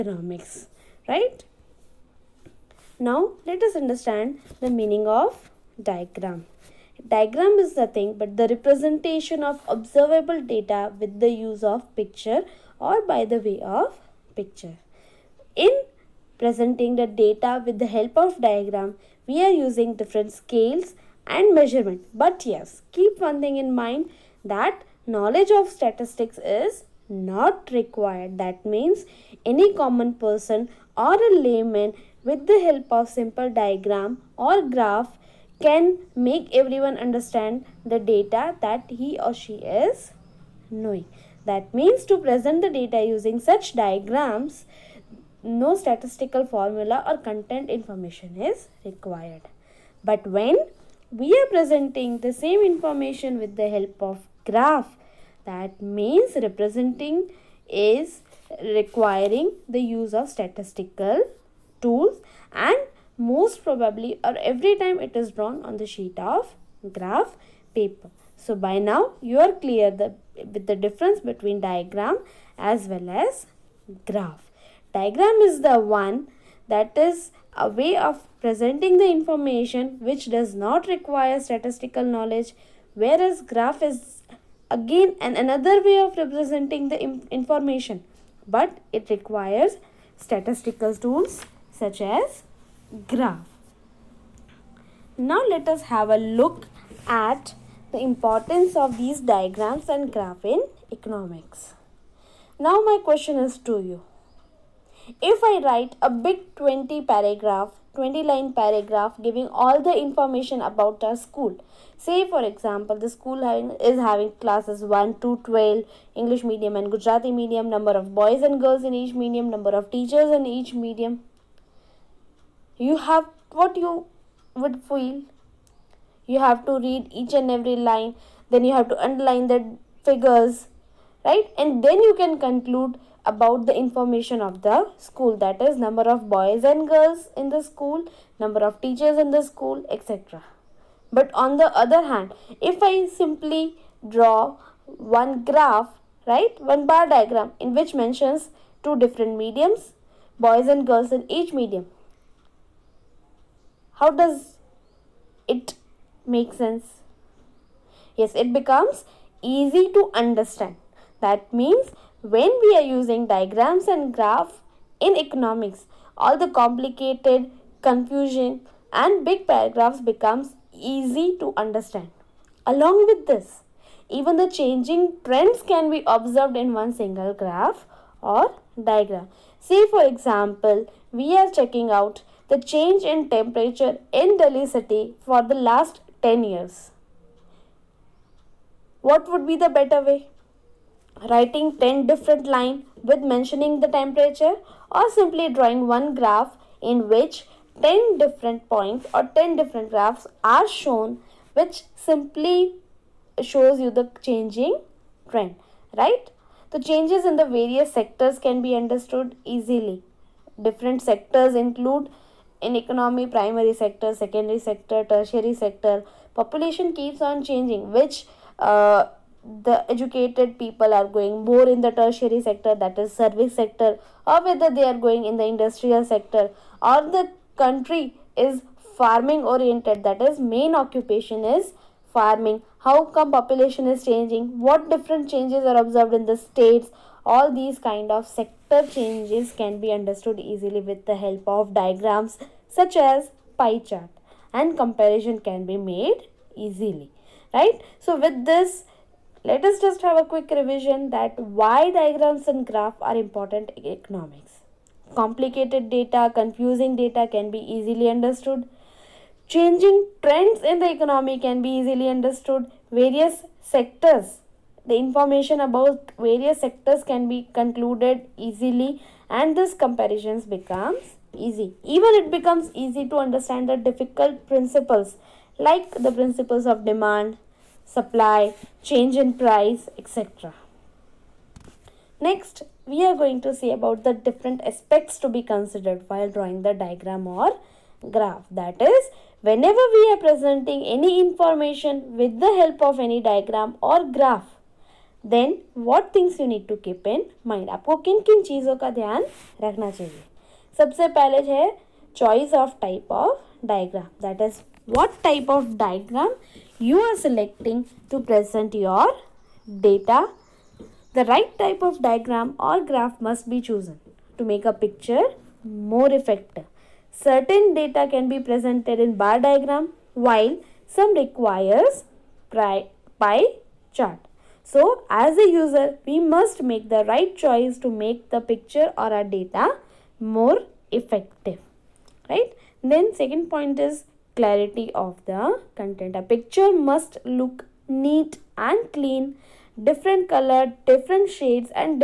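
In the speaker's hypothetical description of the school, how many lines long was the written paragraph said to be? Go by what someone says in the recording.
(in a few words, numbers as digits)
20.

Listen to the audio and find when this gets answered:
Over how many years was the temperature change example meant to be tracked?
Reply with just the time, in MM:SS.
03:05.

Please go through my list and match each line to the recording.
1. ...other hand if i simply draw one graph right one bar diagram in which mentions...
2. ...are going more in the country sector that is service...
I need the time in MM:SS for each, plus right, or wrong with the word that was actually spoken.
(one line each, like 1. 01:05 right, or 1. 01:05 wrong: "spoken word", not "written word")
1. 02:21 right
2. 03:40 wrong: "tertiary", not "country".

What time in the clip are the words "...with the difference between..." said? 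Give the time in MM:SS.
01:10.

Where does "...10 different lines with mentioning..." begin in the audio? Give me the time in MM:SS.
03:11.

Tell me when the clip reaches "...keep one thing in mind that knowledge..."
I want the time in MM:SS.
00:22.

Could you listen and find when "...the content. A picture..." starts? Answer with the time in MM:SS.
05:35.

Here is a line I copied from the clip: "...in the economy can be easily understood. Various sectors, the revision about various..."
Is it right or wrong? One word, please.
wrong.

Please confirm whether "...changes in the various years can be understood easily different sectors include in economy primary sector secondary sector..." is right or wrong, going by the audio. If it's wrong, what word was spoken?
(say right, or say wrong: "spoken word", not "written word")
wrong: "sectors", not "years".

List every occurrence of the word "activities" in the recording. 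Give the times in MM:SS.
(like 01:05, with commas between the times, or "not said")
not said.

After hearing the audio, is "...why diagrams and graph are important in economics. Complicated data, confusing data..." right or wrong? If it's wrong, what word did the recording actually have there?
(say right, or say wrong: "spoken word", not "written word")
right.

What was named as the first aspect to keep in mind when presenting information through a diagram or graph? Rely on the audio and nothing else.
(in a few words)
Choice of type of diagram.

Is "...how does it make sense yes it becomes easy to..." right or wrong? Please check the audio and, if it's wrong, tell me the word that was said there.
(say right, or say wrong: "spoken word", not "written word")
right.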